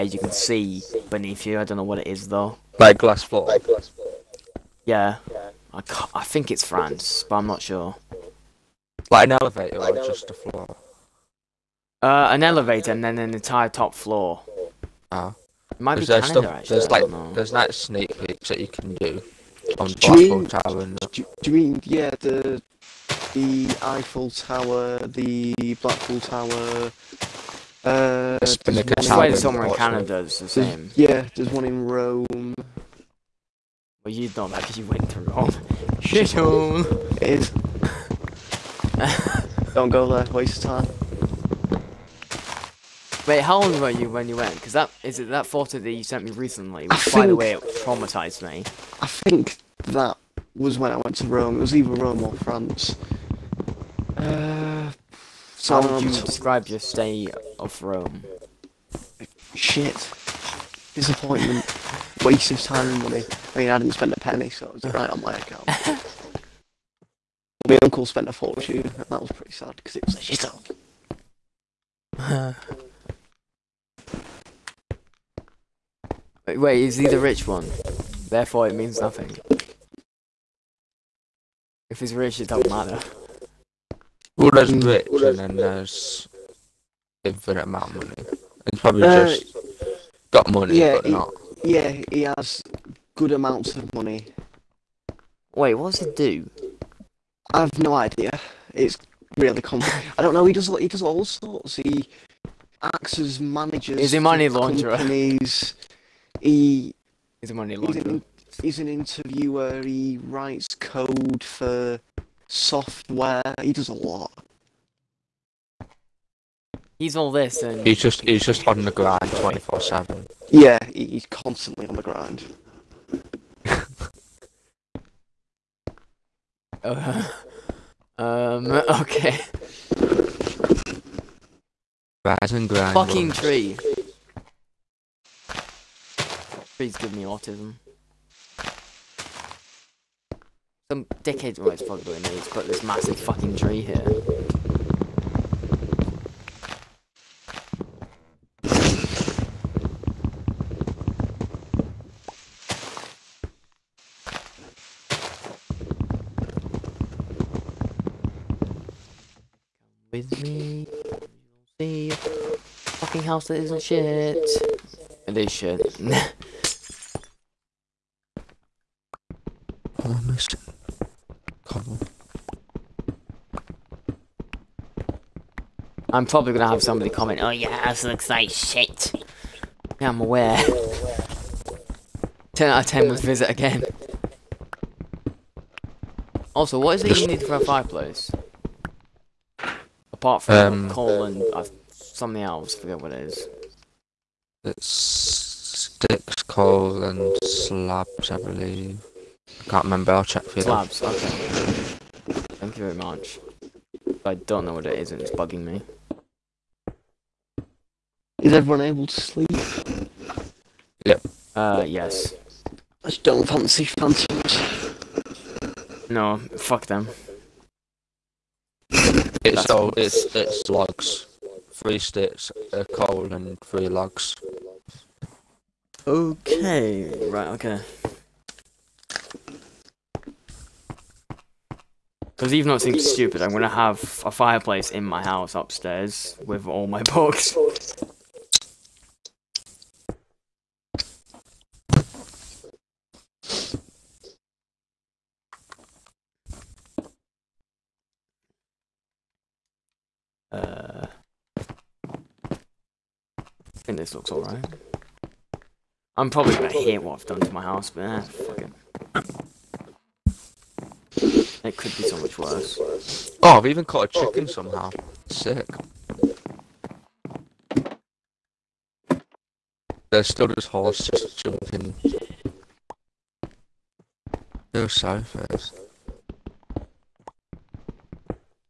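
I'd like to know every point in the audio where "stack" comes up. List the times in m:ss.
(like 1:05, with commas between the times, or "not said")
not said.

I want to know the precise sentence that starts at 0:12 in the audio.
Uh, an elevator and then an entire top floor.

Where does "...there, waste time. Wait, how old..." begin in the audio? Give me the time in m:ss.
0:40.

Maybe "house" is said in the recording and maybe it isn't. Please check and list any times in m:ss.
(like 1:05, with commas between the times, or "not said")
2:43, 3:55, 4:17.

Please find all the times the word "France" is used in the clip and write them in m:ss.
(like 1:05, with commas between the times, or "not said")
0:06, 0:52.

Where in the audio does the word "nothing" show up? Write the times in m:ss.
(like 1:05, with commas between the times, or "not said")
1:19.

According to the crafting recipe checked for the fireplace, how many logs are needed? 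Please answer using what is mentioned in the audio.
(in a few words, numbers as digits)
3.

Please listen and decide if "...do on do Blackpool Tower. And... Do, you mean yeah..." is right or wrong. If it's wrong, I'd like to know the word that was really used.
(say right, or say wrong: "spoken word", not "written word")
right.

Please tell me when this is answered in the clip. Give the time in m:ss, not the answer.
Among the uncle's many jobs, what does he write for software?
1:50.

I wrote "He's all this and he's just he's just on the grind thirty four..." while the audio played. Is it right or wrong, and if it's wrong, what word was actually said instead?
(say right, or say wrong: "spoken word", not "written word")
wrong: "twenty", not "thirty".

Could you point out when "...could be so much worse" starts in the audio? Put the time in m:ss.
4:21.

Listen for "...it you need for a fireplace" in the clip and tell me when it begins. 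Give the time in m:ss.
3:07.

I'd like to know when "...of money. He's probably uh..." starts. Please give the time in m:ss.
1:27.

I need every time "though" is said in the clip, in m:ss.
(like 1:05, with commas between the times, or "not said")
0:02, 3:21, 3:52.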